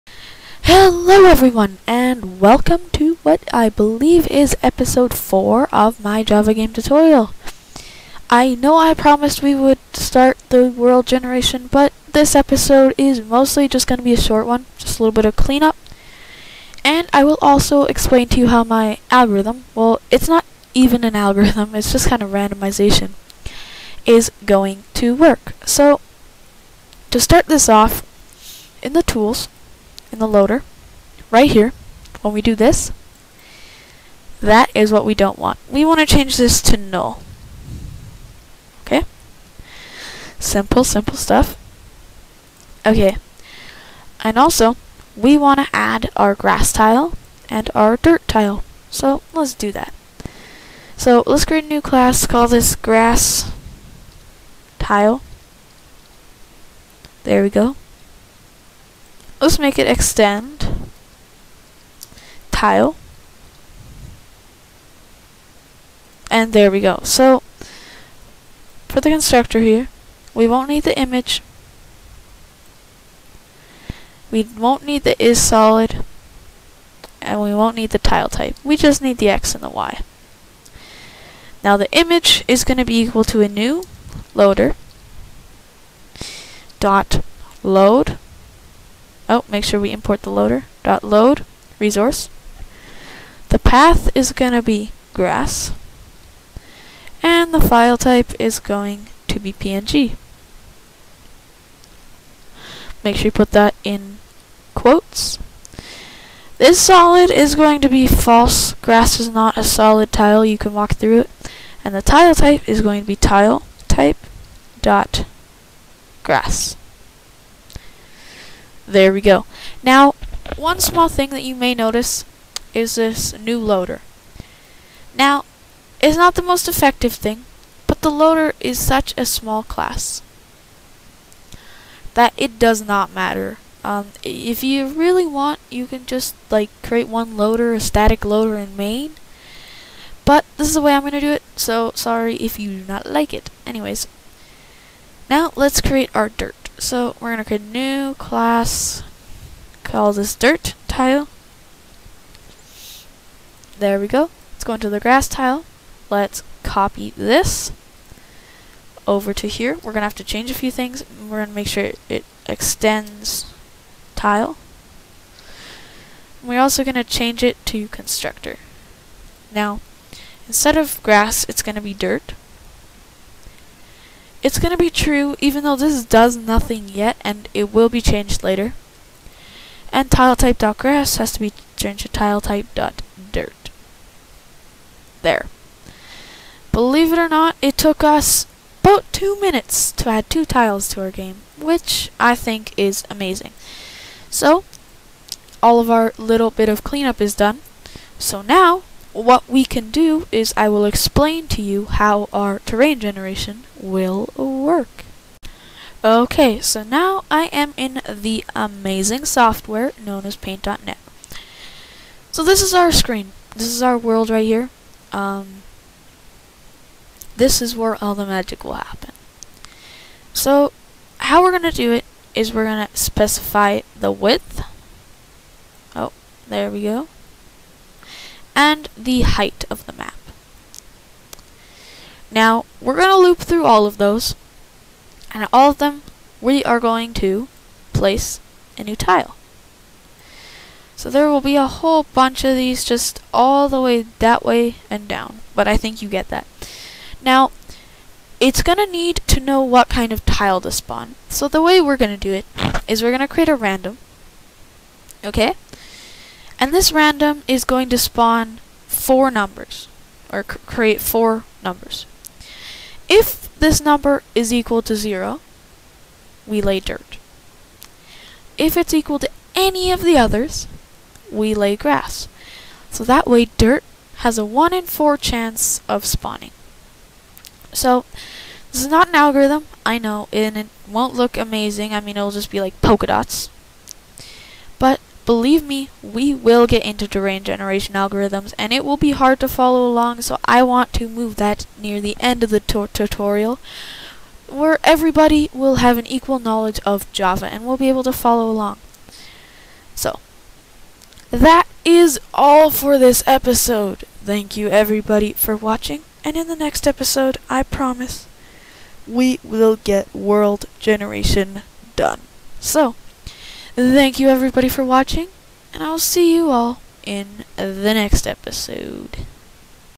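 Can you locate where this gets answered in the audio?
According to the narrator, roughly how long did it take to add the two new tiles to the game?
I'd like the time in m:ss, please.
3:09.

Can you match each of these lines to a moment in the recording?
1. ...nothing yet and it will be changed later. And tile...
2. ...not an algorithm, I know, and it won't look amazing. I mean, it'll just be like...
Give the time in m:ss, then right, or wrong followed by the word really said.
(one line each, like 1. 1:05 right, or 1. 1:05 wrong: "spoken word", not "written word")
1. 2:56 right
2. 4:38 right.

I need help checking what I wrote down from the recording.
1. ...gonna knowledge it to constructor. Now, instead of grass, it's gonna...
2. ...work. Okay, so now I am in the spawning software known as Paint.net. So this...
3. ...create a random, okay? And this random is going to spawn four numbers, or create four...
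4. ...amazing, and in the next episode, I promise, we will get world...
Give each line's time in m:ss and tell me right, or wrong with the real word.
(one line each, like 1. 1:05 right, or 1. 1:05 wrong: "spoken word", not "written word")
1. 2:46 wrong: "change", not "knowledge"
2. 3:24 wrong: "amazing", not "spawning"
3. 4:13 right
4. 5:05 wrong: "watching", not "amazing".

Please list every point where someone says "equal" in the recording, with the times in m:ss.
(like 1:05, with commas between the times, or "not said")
1:23, 4:24, 4:28, 4:56.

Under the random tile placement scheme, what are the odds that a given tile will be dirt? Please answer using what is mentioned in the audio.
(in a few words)
1 in 4.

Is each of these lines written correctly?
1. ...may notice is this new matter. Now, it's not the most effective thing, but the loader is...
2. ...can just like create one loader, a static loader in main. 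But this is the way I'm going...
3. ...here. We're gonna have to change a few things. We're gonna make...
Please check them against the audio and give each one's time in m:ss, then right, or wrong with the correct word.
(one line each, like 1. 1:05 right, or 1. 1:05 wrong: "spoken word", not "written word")
1. 2:01 wrong: "loader", not "matter"
2. 2:15 right
3. 2:39 right.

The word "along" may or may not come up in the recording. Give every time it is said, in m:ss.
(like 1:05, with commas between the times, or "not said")
4:49, 4:58.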